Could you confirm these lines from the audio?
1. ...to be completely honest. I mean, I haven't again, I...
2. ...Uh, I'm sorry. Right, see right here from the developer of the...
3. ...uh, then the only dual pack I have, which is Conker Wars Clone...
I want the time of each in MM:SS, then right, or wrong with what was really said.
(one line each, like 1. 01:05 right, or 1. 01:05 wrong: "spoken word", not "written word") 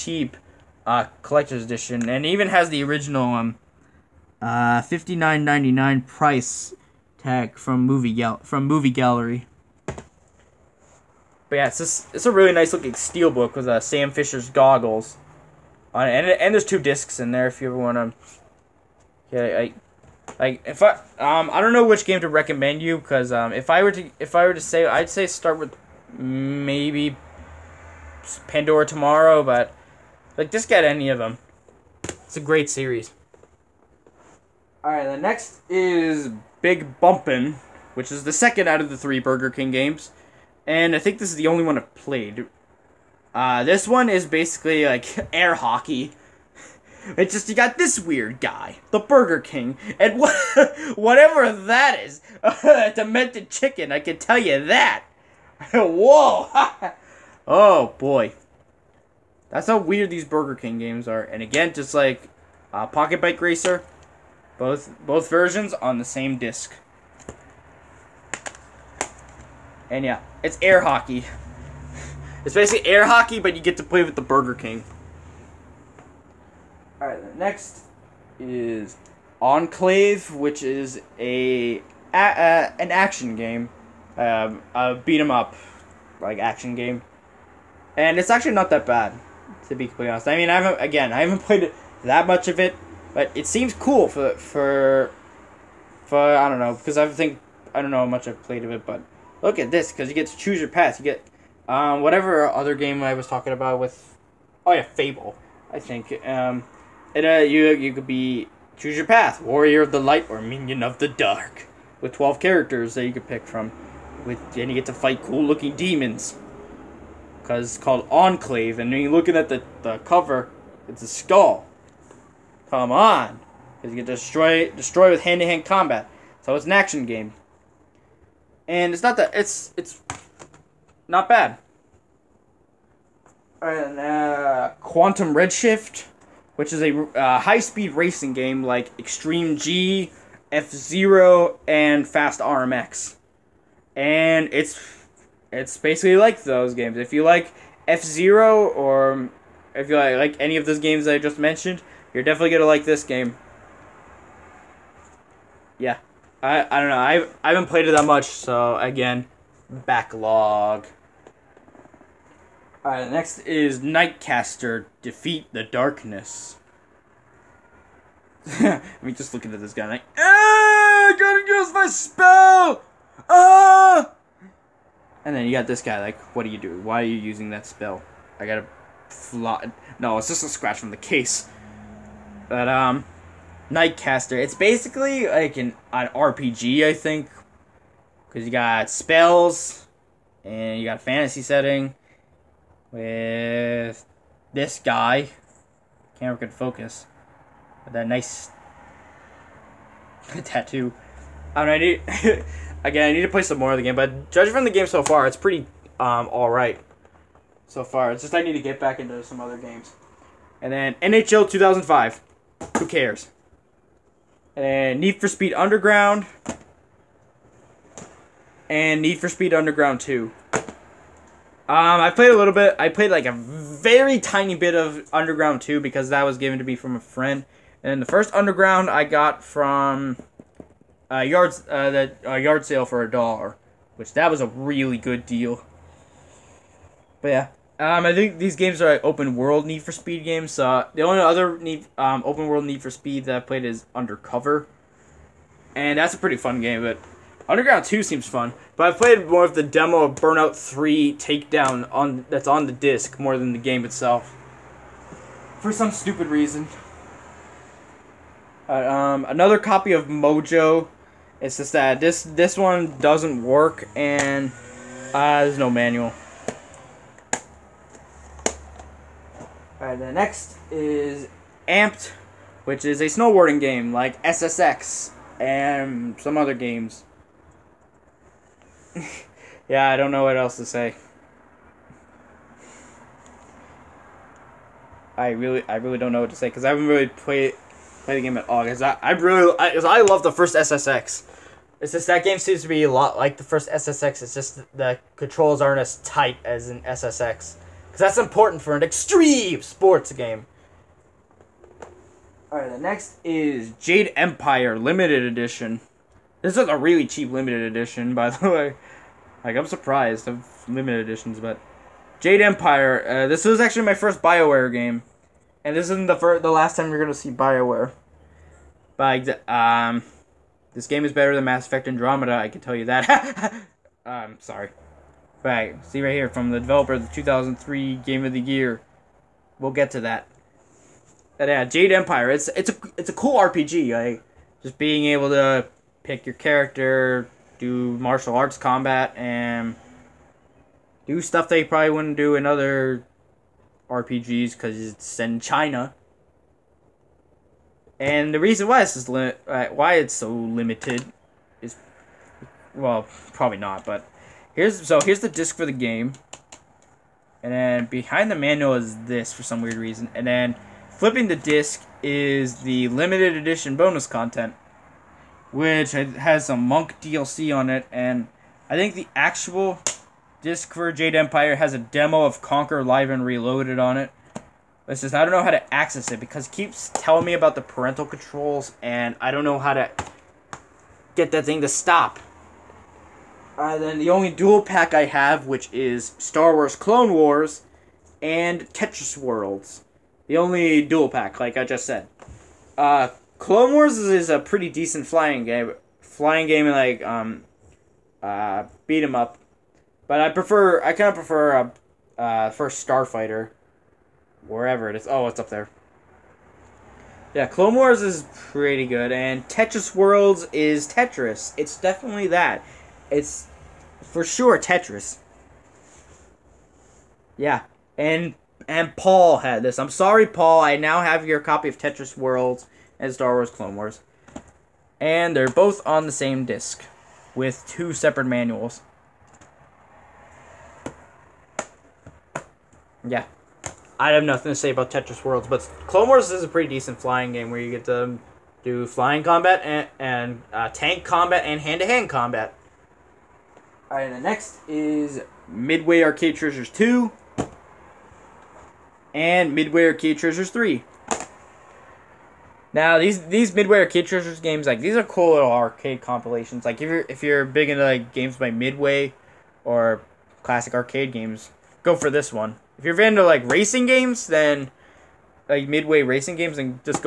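1. 01:29 right
2. 05:24 right
3. 06:23 wrong: "Star", not "Conker".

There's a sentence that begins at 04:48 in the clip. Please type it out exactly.
Cause I, I really, I, cause I love the first SSX.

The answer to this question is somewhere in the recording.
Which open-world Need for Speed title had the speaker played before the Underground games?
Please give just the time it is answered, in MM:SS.
04:03.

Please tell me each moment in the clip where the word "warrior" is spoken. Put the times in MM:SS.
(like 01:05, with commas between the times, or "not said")
01:49.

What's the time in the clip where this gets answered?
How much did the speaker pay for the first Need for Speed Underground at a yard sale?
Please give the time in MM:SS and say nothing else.
03:53.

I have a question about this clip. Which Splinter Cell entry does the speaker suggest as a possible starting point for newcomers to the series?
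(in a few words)
Pandora Tomorrow.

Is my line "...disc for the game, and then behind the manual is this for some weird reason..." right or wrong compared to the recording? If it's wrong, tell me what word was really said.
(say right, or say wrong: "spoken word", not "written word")
right.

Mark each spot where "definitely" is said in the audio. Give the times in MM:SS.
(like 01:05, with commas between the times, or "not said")
02:32, 06:51.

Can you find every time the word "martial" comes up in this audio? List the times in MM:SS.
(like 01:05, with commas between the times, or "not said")
05:37.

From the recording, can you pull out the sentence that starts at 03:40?
Um, I played a little bit.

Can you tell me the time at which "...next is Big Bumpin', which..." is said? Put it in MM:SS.
00:35.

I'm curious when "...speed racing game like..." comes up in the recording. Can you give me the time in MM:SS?
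02:17.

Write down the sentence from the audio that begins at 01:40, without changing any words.
You get um, whatever other game I was talking about with oh yeah Fable, I think.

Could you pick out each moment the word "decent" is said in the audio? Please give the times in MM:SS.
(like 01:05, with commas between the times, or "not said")
06:34, 07:16.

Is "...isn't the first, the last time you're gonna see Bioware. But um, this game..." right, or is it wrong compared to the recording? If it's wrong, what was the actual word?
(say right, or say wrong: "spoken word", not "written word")
right.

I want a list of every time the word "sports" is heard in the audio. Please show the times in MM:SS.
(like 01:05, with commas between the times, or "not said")
04:59.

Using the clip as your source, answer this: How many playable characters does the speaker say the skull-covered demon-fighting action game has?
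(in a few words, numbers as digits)
12.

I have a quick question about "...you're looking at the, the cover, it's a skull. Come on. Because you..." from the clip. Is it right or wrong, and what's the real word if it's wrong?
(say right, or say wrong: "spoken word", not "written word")
right.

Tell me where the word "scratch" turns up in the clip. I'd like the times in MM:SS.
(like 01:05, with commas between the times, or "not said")
03:00.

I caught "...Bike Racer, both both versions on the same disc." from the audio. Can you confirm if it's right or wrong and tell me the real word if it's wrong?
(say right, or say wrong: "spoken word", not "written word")
right.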